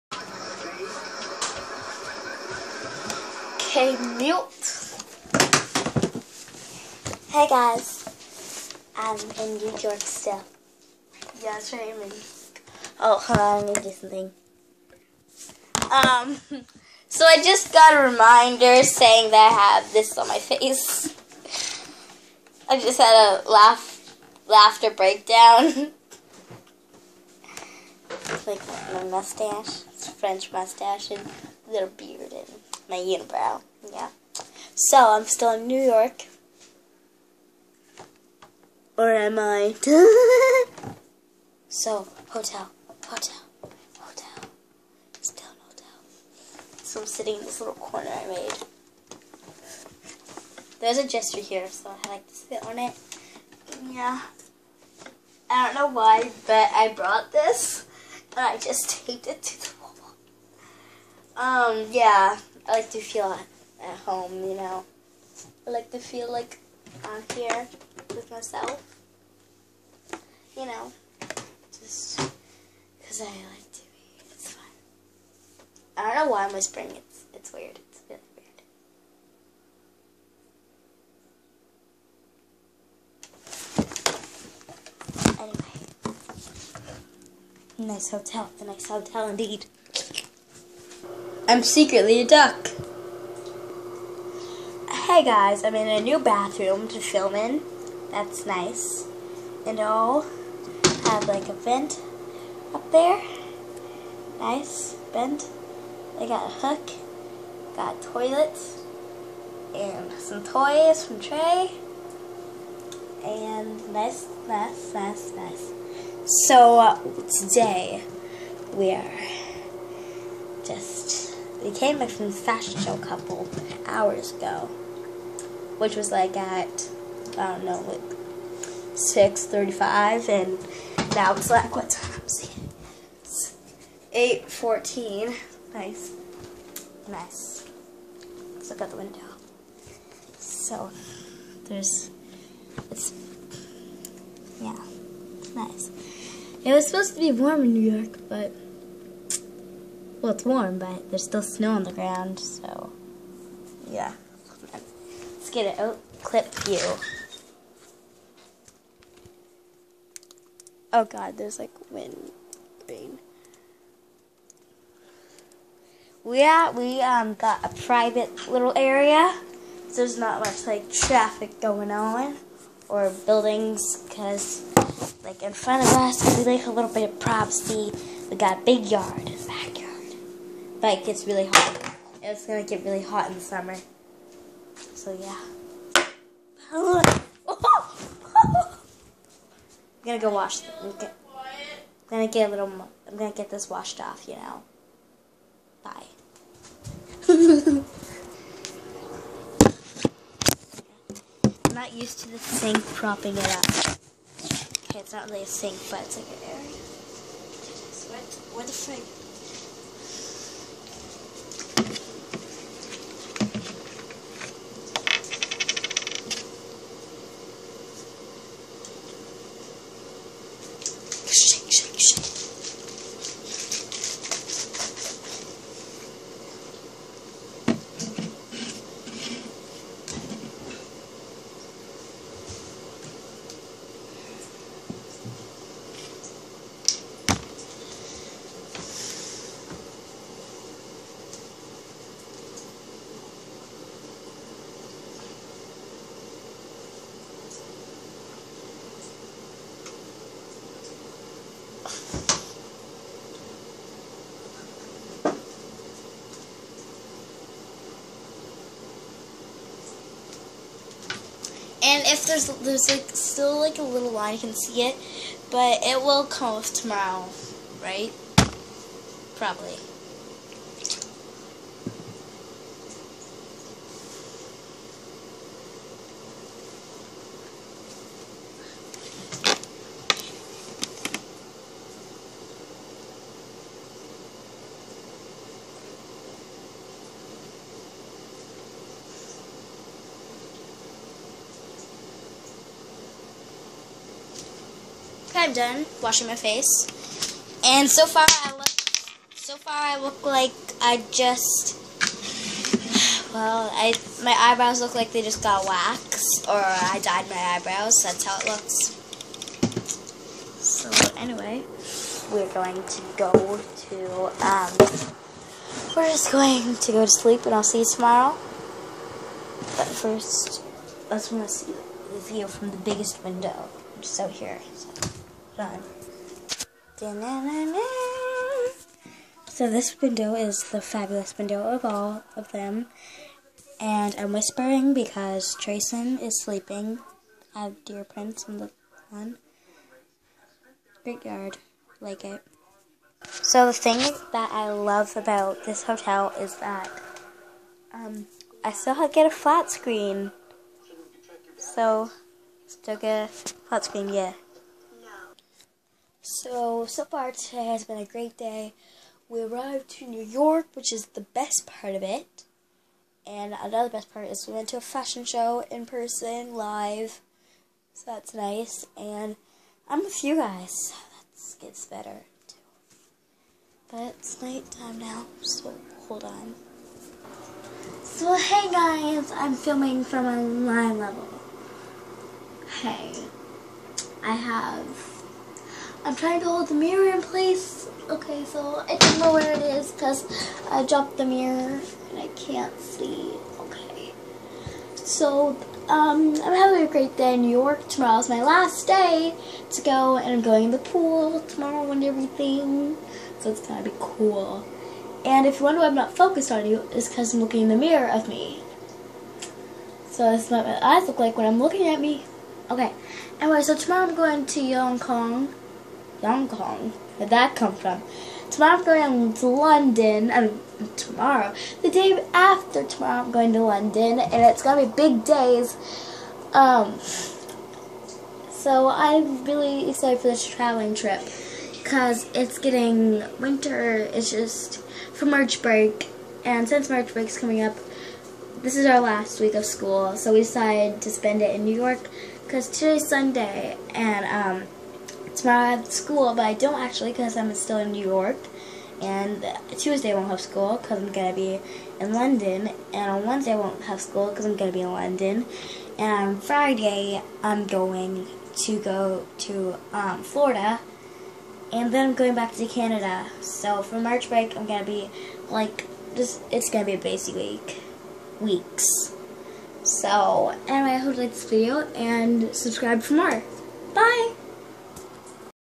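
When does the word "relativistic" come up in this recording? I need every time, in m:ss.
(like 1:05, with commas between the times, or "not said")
not said.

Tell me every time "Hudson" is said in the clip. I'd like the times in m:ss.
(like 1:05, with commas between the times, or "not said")
not said.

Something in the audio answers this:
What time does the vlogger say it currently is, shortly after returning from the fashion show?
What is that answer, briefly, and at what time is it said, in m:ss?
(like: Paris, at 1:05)
8:14, at 2:14.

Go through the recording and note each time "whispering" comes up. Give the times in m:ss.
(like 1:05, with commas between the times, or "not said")
1:16, 5:34.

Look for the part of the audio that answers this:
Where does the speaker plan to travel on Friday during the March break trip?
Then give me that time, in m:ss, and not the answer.
7:40.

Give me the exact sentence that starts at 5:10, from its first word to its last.
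So anyway, we're going to go to um we're just going to go to sleep and I'll see you tomorrow.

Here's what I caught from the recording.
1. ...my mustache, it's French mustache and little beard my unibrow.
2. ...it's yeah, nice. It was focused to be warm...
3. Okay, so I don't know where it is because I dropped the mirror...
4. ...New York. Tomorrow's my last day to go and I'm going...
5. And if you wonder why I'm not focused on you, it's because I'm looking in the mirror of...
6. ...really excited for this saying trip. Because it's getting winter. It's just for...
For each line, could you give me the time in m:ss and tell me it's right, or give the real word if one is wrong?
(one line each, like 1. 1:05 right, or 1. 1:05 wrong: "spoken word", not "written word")
1. 0:28 right
2. 2:22 wrong: "supposed", not "focused"
3. 6:28 right
4. 6:37 right
5. 6:45 right
6. 7:09 wrong: "traveling", not "saying".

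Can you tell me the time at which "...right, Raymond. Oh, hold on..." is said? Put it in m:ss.
0:11.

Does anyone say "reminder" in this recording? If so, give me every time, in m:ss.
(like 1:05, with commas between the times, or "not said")
0:18.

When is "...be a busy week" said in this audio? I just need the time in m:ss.
7:46.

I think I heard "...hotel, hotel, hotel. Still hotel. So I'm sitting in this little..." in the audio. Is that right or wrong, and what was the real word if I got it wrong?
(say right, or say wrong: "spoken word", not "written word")
right.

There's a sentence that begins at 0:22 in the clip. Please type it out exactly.
I just had a laugh, laughter breakdown.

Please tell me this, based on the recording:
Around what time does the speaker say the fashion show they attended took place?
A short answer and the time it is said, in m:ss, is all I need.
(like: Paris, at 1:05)
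6:35, at 2:08.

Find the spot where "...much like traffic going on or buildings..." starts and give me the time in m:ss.
2:50.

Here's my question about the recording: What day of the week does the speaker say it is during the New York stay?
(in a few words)
Sunday.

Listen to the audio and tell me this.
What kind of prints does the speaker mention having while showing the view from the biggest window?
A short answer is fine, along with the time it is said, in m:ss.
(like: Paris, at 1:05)
deer prints, at 5:37.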